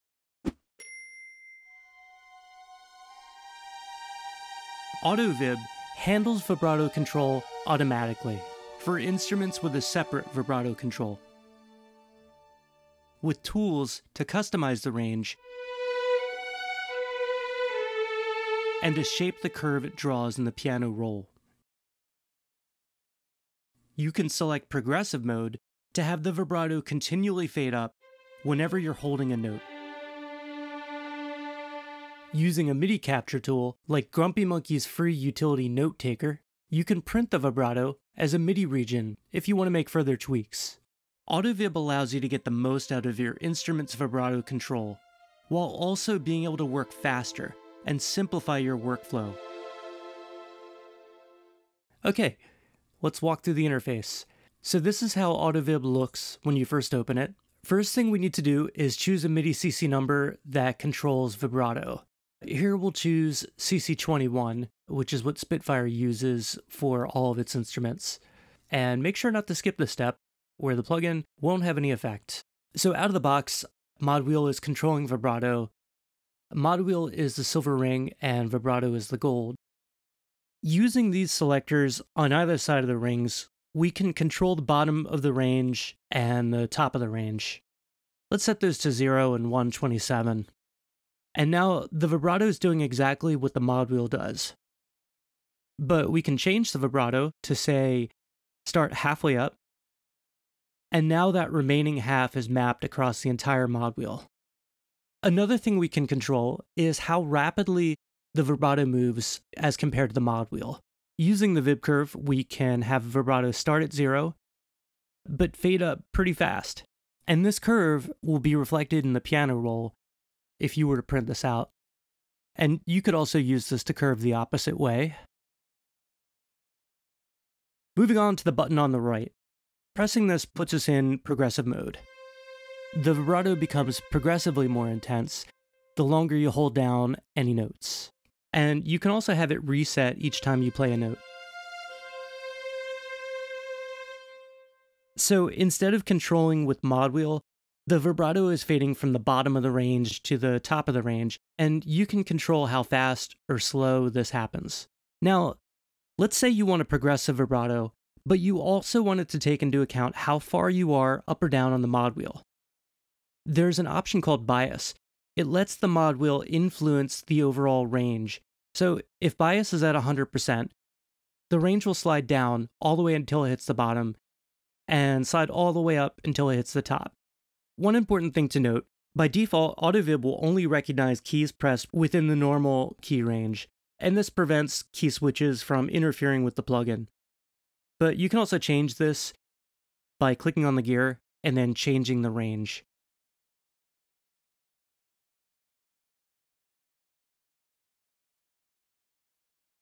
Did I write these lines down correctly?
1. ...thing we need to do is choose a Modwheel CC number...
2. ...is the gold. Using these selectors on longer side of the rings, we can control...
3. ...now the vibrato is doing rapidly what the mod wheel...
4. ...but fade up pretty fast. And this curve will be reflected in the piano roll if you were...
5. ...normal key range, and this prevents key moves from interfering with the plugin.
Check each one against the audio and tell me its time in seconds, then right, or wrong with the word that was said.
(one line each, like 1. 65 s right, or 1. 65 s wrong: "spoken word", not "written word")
1. 57 s wrong: "MIDI", not "Modwheel"
2. 78 s wrong: "either", not "longer"
3. 91 s wrong: "exactly", not "rapidly"
4. 115 s right
5. 182 s wrong: "switches", not "moves".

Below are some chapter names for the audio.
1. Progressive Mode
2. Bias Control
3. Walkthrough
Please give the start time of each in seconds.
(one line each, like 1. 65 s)
1. 128 s
2. 155 s
3. 50 s.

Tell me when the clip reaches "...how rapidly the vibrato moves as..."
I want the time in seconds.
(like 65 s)
106 s.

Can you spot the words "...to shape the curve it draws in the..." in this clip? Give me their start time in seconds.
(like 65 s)
18 s.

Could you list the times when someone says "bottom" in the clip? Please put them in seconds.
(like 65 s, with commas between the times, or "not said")
84 s, 149 s, 173 s.